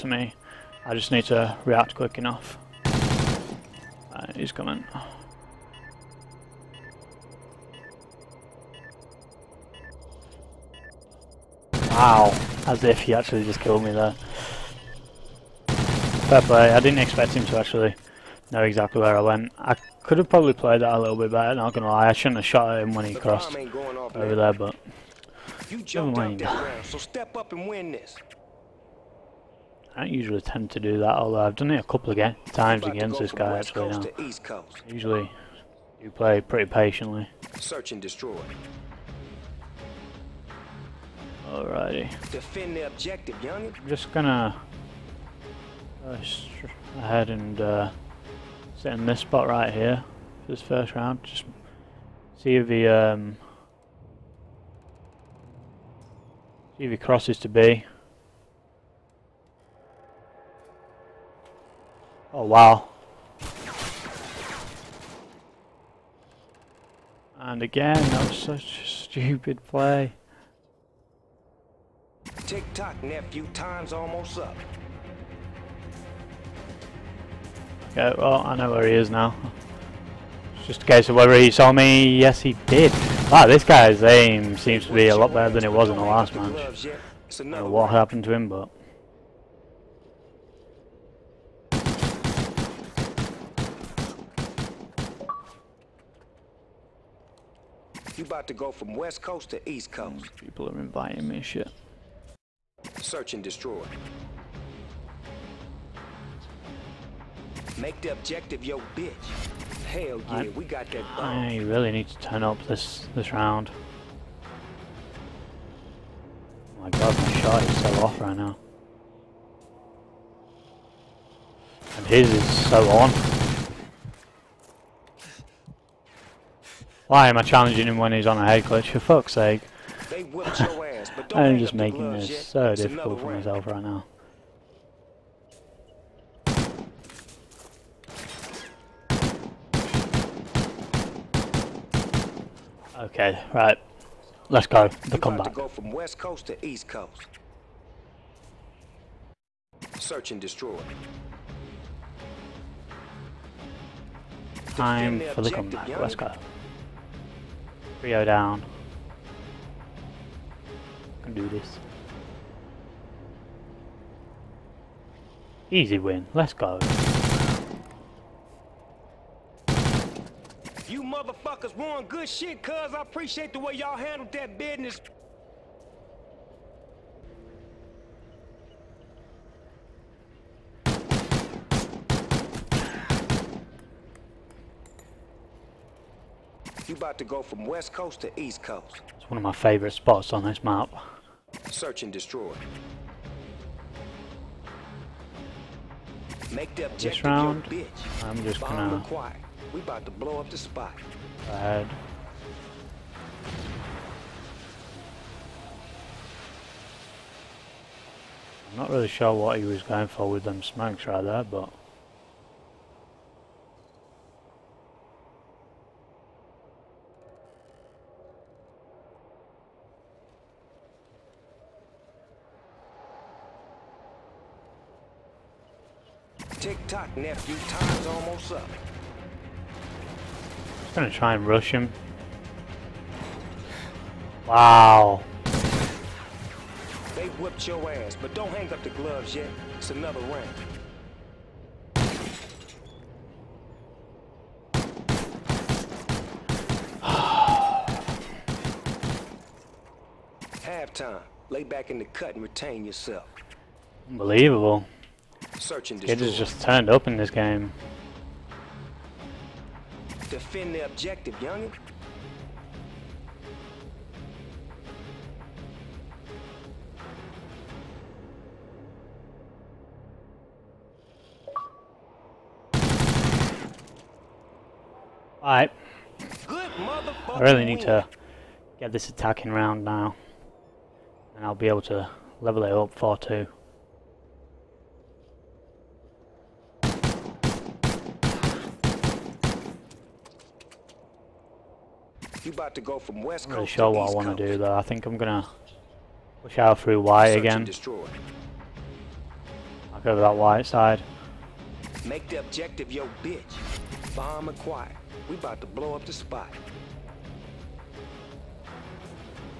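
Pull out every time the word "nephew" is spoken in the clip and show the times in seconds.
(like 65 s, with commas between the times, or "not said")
73 s, 227 s.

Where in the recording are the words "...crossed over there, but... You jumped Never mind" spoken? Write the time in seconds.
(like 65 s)
23 s.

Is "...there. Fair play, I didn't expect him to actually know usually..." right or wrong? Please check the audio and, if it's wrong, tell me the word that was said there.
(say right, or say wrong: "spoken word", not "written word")
wrong: "exactly", not "usually".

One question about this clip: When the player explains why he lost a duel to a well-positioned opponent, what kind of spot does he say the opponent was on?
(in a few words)
head glitch.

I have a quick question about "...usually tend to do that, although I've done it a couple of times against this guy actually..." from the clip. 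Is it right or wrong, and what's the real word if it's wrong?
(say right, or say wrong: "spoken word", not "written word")
right.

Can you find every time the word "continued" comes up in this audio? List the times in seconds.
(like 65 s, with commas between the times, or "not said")
not said.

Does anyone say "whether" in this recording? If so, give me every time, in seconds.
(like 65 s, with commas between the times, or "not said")
81 s.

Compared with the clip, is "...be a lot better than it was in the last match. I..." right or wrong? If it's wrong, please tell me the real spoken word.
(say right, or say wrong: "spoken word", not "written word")
right.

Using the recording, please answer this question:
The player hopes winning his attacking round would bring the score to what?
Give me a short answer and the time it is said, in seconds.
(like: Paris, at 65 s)
4-2, at 282 s.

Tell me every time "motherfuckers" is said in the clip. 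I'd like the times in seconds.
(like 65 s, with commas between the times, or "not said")
171 s.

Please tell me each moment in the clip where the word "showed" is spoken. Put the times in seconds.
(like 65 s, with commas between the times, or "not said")
not said.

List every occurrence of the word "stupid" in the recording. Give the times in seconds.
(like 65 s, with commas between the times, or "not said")
68 s.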